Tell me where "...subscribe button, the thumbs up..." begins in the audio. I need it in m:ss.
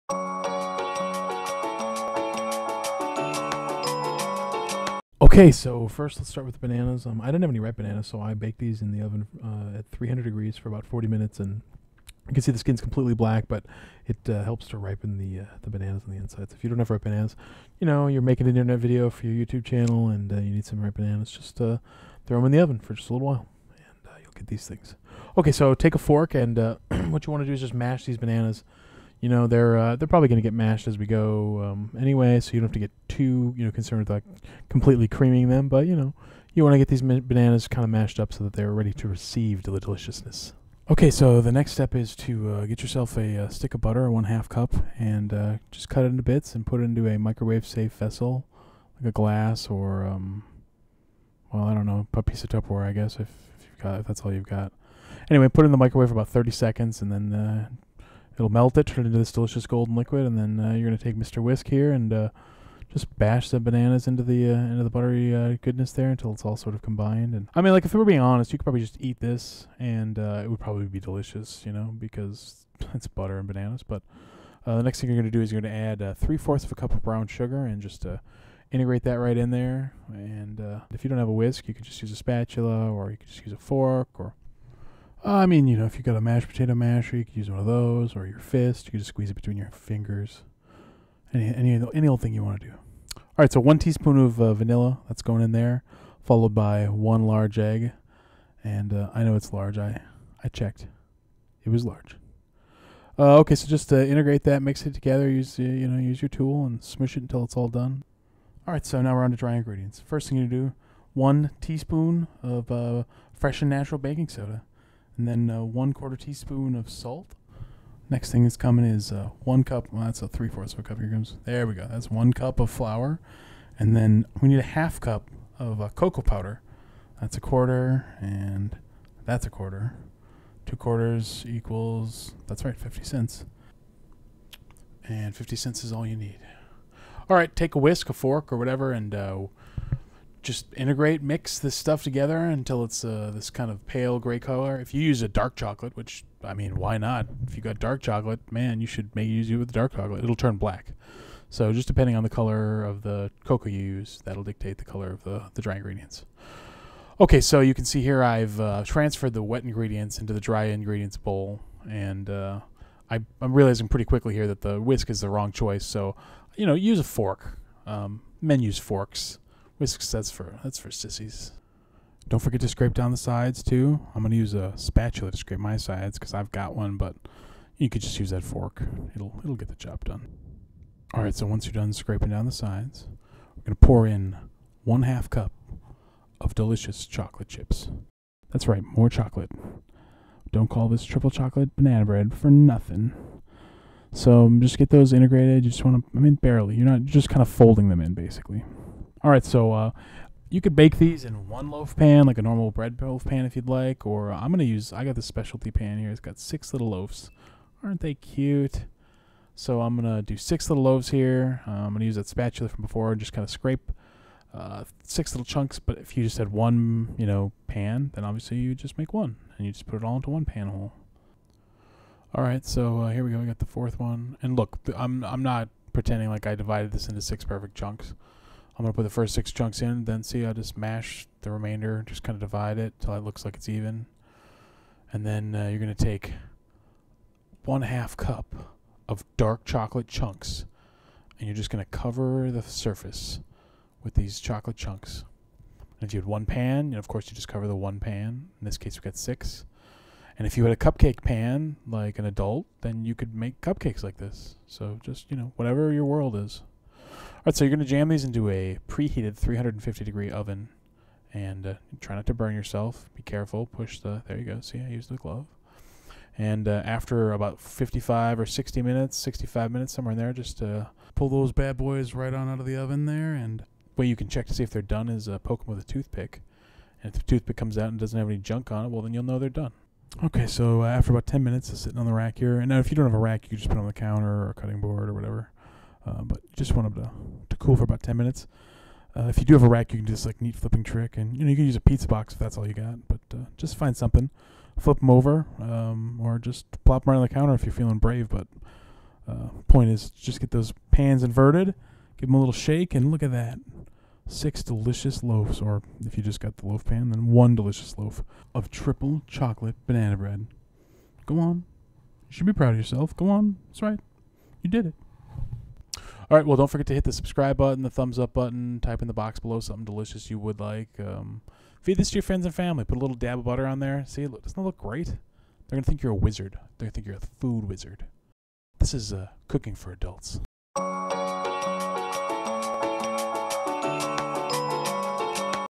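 5:17.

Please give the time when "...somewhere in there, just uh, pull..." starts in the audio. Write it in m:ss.
4:29.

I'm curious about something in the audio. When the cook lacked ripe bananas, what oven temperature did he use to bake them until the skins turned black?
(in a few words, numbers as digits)
300 degrees.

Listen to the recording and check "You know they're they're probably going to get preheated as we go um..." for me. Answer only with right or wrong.
wrong.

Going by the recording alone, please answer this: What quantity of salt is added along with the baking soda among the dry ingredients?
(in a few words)
1/4 teaspoon.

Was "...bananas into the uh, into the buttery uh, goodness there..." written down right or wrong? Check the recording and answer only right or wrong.
right.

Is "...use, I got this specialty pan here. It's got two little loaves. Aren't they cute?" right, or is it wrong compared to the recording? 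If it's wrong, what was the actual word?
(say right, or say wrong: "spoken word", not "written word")
wrong: "six", not "two".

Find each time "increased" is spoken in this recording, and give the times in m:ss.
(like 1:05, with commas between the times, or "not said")
not said.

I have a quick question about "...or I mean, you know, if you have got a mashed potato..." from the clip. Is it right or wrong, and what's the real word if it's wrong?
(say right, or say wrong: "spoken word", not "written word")
right.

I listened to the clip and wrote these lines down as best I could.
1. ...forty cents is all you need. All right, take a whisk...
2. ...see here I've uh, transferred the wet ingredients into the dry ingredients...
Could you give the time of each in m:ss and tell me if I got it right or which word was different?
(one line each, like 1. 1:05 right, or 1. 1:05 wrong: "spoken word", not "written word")
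1. 2:15 wrong: "fifty", not "forty"
2. 2:37 right.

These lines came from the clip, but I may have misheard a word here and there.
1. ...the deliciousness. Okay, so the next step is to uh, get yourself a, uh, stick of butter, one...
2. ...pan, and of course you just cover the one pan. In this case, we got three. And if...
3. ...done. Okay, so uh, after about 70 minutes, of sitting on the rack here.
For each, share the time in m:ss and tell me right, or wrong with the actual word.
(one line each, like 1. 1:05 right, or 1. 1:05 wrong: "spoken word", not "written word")
1. 0:39 right
2. 4:06 wrong: "six", not "three"
3. 4:39 wrong: "10", not "70".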